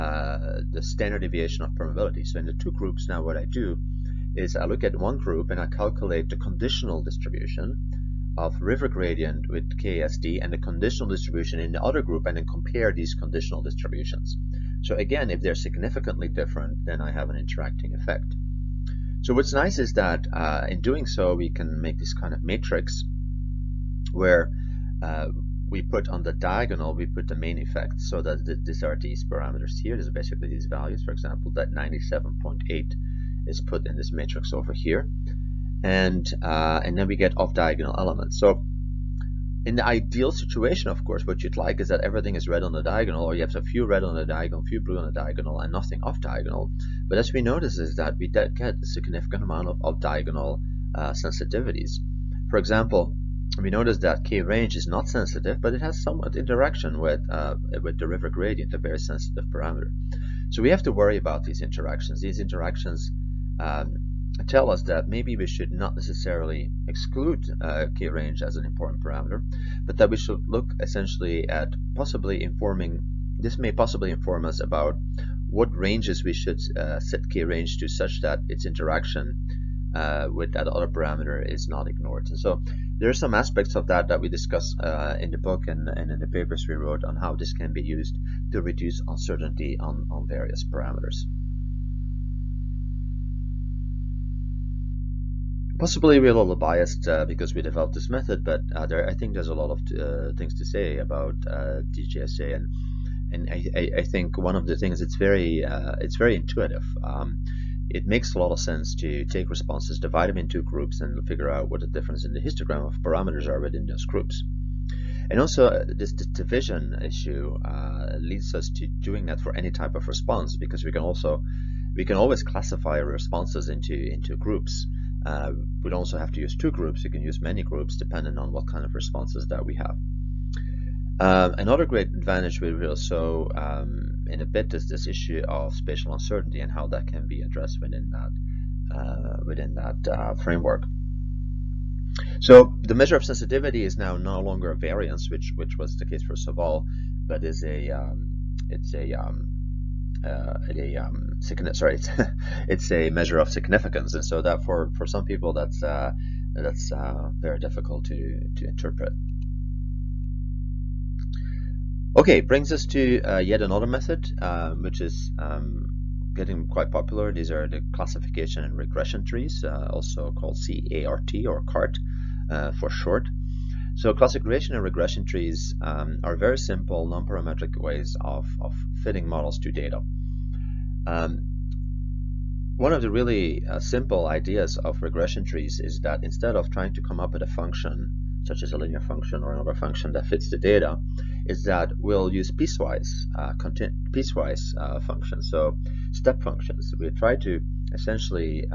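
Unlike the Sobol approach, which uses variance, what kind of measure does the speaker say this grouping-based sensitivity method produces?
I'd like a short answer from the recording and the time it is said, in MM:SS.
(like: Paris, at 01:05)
a measure of significance, at 02:33.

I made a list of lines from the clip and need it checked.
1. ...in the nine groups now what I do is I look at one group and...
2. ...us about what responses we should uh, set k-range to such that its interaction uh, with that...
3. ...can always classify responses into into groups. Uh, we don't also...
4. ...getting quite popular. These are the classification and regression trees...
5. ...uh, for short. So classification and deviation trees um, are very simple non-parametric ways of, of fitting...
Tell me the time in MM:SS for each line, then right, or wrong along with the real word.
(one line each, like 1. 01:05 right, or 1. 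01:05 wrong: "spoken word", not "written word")
1. 00:02 wrong: "two", not "nine"
2. 01:14 wrong: "ranges", not "responses"
3. 02:02 right
4. 02:46 right
5. 02:52 wrong: "regression", not "deviation".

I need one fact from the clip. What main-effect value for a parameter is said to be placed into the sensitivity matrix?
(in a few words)
97.8.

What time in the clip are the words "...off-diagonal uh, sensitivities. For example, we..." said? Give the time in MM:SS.
00:49.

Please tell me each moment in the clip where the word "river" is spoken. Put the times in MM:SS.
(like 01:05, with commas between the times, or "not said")
00:08, 00:58.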